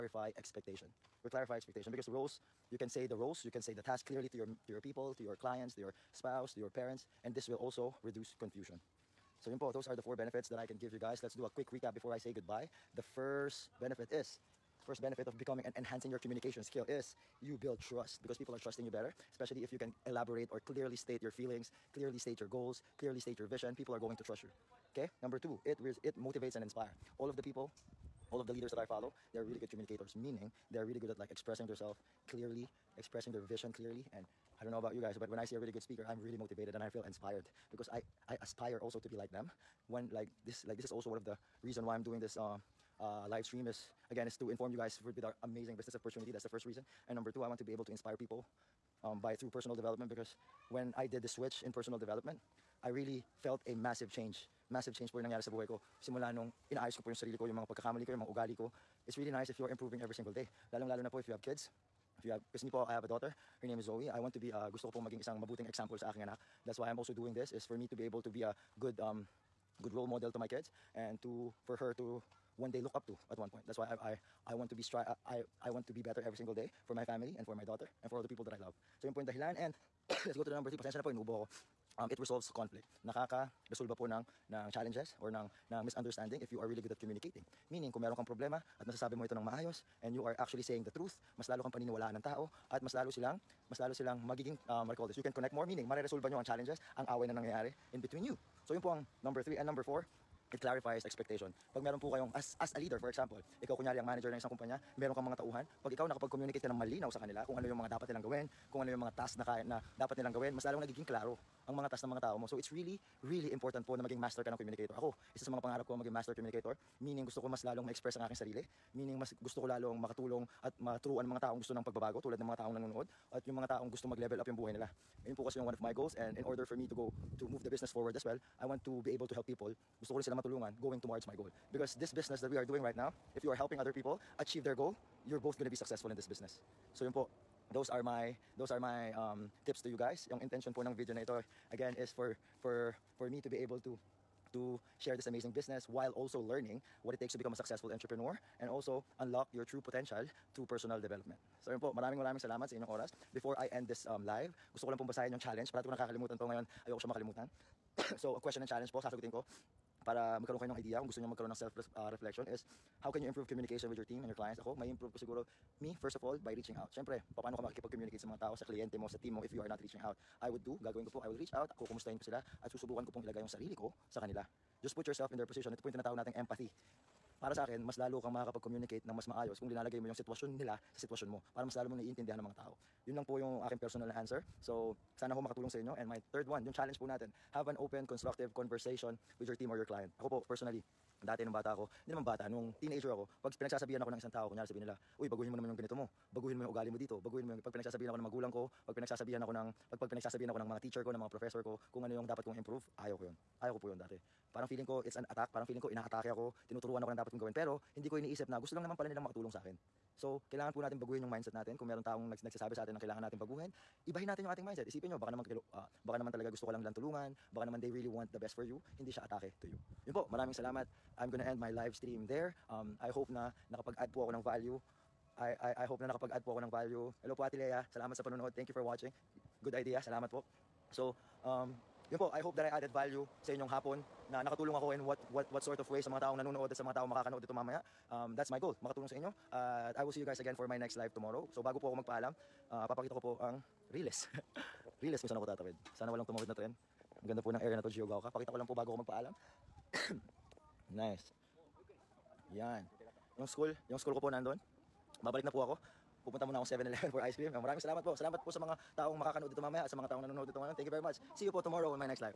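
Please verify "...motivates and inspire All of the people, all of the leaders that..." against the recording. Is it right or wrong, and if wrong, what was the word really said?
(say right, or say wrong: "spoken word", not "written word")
right.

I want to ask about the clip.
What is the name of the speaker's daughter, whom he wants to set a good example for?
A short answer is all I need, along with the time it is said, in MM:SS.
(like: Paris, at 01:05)
Zoe, at 01:03.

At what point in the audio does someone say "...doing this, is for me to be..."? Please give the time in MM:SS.
01:07.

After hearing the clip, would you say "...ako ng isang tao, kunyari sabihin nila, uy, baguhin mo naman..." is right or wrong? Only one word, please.
right.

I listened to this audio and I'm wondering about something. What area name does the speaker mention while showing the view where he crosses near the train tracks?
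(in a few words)
Geogaoka.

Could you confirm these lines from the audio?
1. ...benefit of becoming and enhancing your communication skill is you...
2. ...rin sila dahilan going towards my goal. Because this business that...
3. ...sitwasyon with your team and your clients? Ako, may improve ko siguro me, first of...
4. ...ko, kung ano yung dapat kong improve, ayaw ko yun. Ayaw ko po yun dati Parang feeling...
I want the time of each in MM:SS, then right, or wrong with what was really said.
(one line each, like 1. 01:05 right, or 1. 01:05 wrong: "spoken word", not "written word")
1. 00:15 right
2. 02:10 wrong: "matulungan", not "dahilan"
3. 02:43 wrong: "communication", not "sitwasyon"
4. 03:21 right.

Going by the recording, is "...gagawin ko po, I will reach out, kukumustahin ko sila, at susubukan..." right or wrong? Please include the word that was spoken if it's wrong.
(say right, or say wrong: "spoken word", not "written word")
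right.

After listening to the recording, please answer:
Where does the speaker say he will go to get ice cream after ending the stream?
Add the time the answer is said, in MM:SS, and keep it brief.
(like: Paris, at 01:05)
7-Eleven, at 04:16.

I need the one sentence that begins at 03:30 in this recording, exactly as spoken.
So, kailangan po natin baguhin yung mindset natin.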